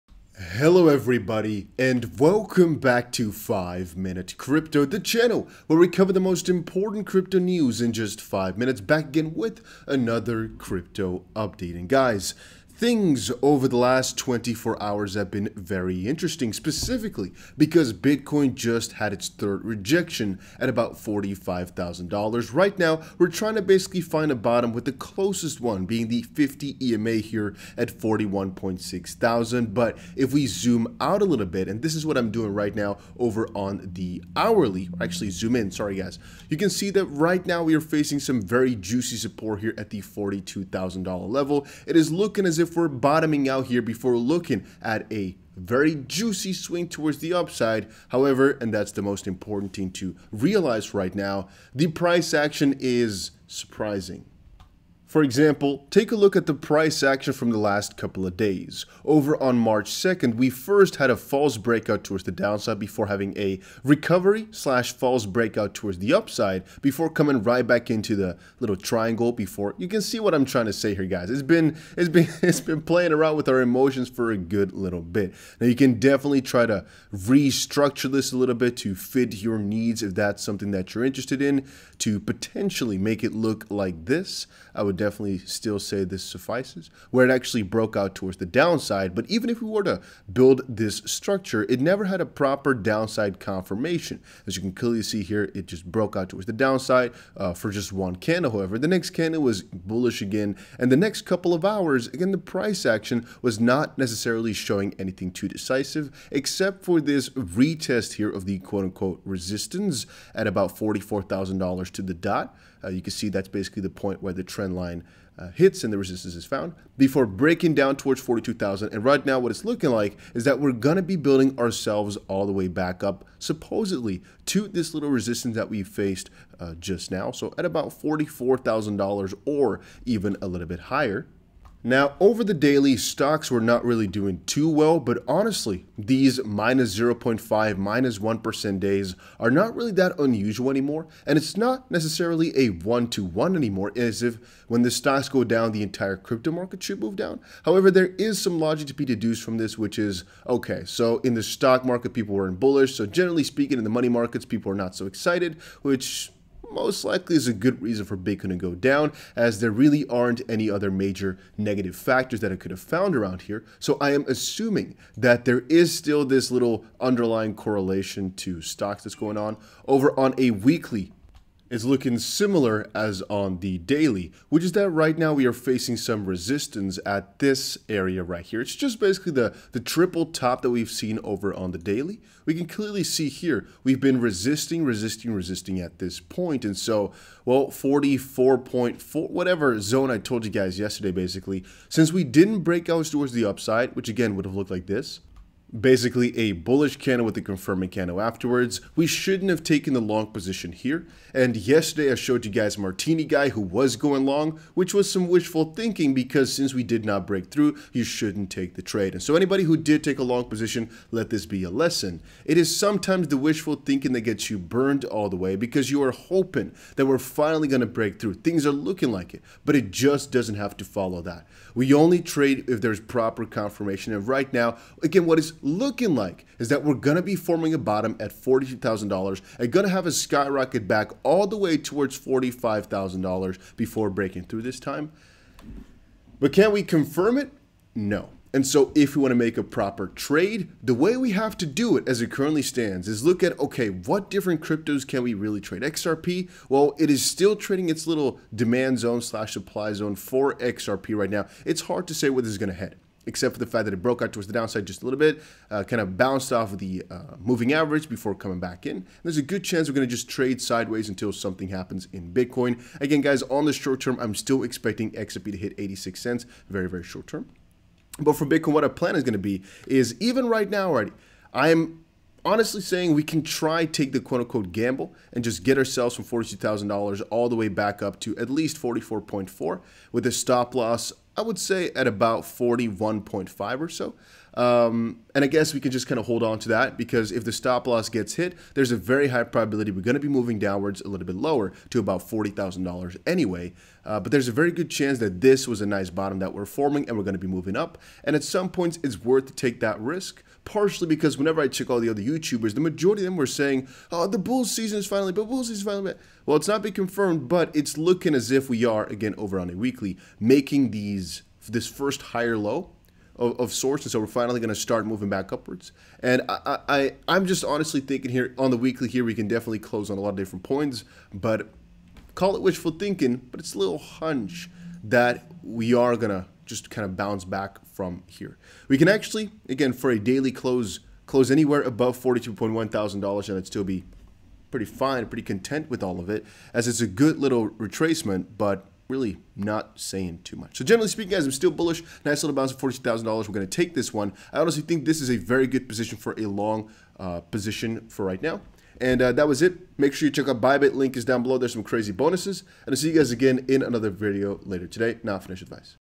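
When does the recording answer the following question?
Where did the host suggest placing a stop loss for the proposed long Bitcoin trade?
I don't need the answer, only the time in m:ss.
4:42.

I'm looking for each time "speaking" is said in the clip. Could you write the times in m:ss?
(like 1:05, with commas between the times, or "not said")
2:33, 5:41.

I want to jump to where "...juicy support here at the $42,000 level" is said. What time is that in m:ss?
0:38.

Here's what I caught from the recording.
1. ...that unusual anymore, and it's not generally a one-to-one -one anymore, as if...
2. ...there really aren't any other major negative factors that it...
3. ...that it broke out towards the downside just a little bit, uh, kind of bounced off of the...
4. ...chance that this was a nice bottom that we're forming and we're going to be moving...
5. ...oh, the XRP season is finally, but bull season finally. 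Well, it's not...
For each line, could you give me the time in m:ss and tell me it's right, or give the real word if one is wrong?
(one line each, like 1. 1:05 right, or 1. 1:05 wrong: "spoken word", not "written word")
1. 2:19 wrong: "necessarily", not "generally"
2. 2:39 right
3. 4:13 right
4. 4:54 right
5. 5:04 wrong: "Bulls", not "XRP".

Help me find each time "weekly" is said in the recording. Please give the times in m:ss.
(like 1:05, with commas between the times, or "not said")
2:50, 5:09, 5:18.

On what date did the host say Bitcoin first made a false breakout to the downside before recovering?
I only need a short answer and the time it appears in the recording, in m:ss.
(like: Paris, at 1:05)
March 2nd, at 0:59.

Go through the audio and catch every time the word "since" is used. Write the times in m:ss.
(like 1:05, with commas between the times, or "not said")
3:11, 3:26.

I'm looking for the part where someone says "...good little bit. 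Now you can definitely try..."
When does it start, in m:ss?
1:14.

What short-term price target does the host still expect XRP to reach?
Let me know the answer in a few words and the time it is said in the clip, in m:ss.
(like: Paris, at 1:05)
86 cents, at 4:25.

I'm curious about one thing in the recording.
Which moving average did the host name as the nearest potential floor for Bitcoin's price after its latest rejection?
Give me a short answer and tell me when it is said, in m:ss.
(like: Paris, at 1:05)
50 EMA, at 0:26.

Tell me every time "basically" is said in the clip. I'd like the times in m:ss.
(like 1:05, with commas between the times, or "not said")
0:23, 1:53, 2:58, 3:11, 3:15.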